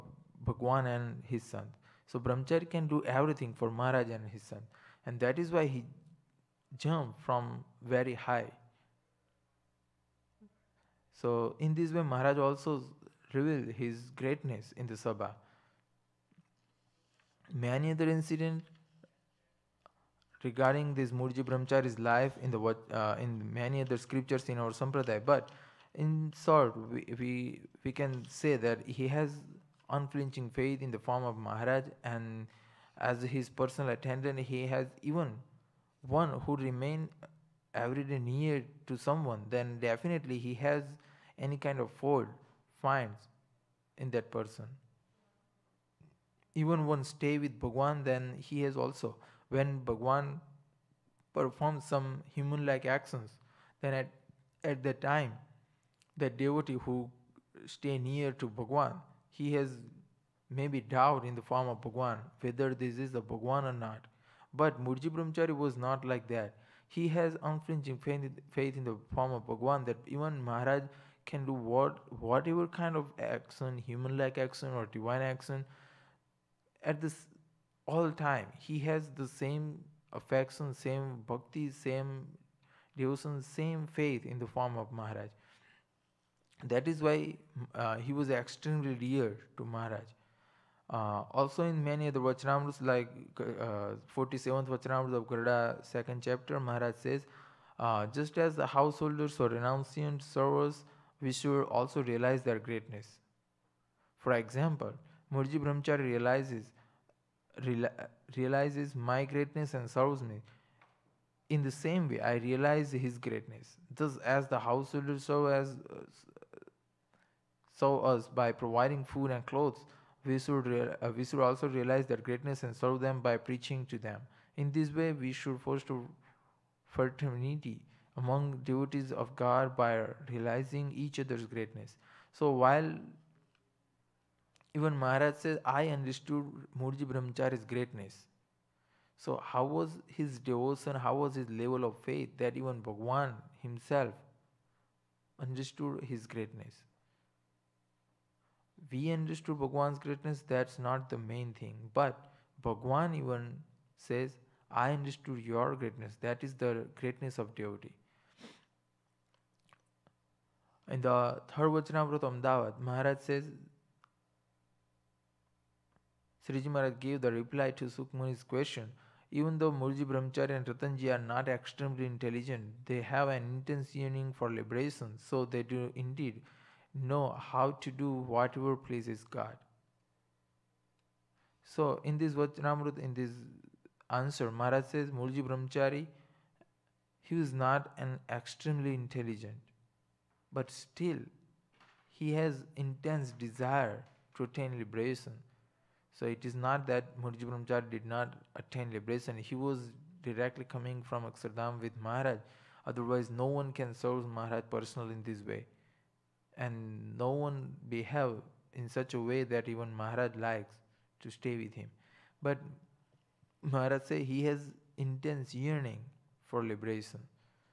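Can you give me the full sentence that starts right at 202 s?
Otherwise, no one can serve Maharaj personally in this way.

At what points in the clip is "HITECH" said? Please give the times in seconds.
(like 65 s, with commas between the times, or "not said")
not said.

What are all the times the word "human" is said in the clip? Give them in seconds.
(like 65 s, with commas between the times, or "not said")
52 s, 73 s.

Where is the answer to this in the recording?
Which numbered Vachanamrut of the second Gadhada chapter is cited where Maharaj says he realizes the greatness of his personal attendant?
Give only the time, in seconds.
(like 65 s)
94 s.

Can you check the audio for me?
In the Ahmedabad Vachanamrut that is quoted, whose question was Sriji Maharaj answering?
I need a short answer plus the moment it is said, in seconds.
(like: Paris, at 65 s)
Shukmuni, at 167 s.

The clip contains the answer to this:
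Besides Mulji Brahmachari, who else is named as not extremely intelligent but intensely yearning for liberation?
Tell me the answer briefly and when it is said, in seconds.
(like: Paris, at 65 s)
Ratanji, at 170 s.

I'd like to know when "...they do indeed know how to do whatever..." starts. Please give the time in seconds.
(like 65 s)
175 s.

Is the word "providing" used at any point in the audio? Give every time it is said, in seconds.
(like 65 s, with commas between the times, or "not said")
118 s.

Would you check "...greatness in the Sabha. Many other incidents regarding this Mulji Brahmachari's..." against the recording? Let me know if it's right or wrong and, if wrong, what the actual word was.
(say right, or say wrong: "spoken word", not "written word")
right.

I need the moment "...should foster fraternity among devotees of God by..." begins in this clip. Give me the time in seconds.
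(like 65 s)
125 s.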